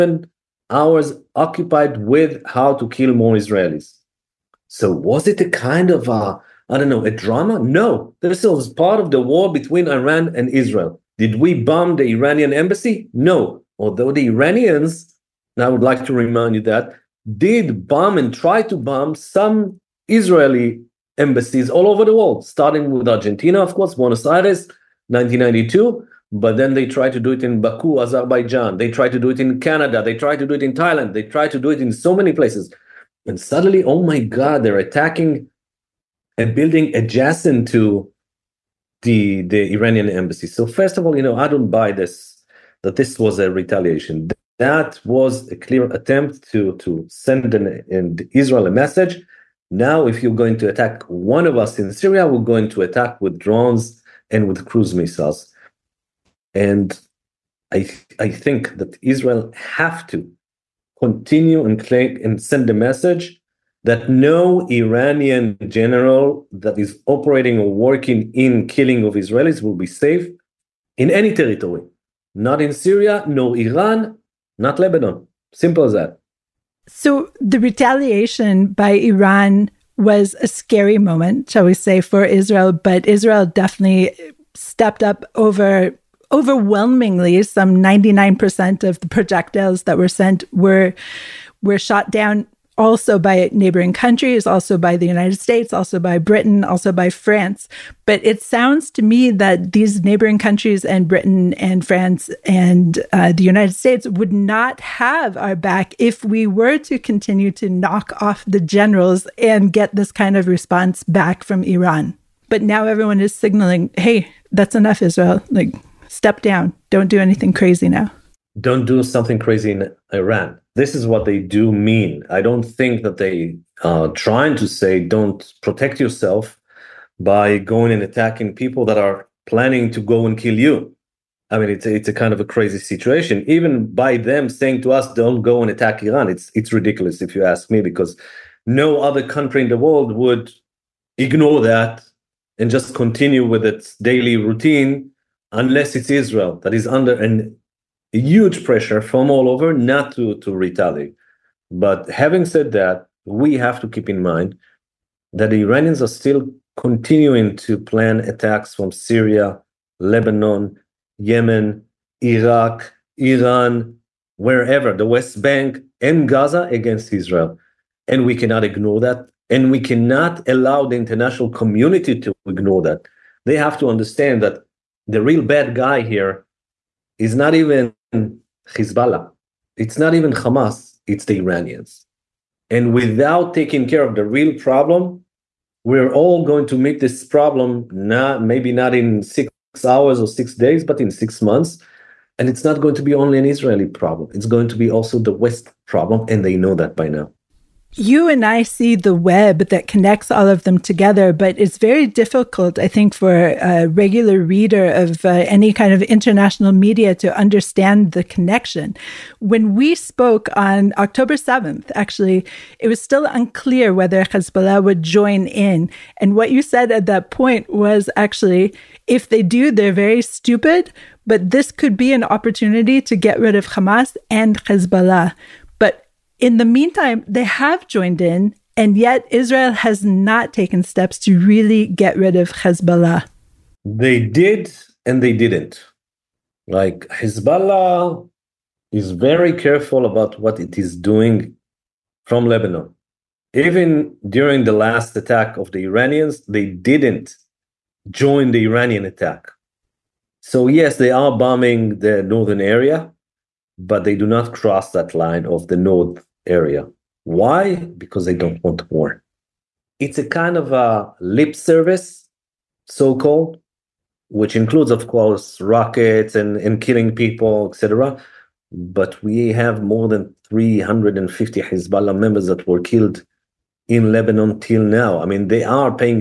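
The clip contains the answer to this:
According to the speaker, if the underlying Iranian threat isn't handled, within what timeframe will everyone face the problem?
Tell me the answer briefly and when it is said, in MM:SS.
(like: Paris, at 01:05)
6 months, at 03:11.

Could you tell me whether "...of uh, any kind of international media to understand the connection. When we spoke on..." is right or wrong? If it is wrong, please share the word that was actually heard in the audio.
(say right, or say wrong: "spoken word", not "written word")
right.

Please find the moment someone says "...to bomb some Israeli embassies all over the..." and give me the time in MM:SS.
00:18.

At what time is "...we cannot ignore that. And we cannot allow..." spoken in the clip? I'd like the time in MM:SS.
02:48.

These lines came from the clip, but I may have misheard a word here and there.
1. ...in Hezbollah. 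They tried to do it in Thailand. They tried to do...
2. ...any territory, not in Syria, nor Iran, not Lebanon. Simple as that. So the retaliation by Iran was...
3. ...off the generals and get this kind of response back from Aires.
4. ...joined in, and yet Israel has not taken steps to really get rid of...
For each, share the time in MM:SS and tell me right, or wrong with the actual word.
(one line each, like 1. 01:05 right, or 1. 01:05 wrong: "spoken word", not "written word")
1. 00:29 wrong: "Canada", not "Hezbollah"
2. 01:11 right
3. 01:48 wrong: "Iran", not "Aires"
4. 03:47 right.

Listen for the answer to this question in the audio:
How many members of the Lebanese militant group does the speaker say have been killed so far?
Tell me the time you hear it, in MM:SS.
04:29.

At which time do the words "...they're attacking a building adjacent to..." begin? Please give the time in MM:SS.
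00:34.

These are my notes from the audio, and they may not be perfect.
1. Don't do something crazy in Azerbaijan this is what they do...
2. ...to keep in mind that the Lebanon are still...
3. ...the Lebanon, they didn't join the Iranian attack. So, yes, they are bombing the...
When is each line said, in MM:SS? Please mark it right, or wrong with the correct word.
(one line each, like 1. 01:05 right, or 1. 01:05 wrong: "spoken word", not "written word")
1. 01:58 wrong: "Iran", not "Azerbaijan"
2. 02:33 wrong: "Iranians", not "Lebanon"
3. 04:05 wrong: "Iranians", not "Lebanon".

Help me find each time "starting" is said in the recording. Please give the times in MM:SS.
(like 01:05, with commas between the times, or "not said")
00:22.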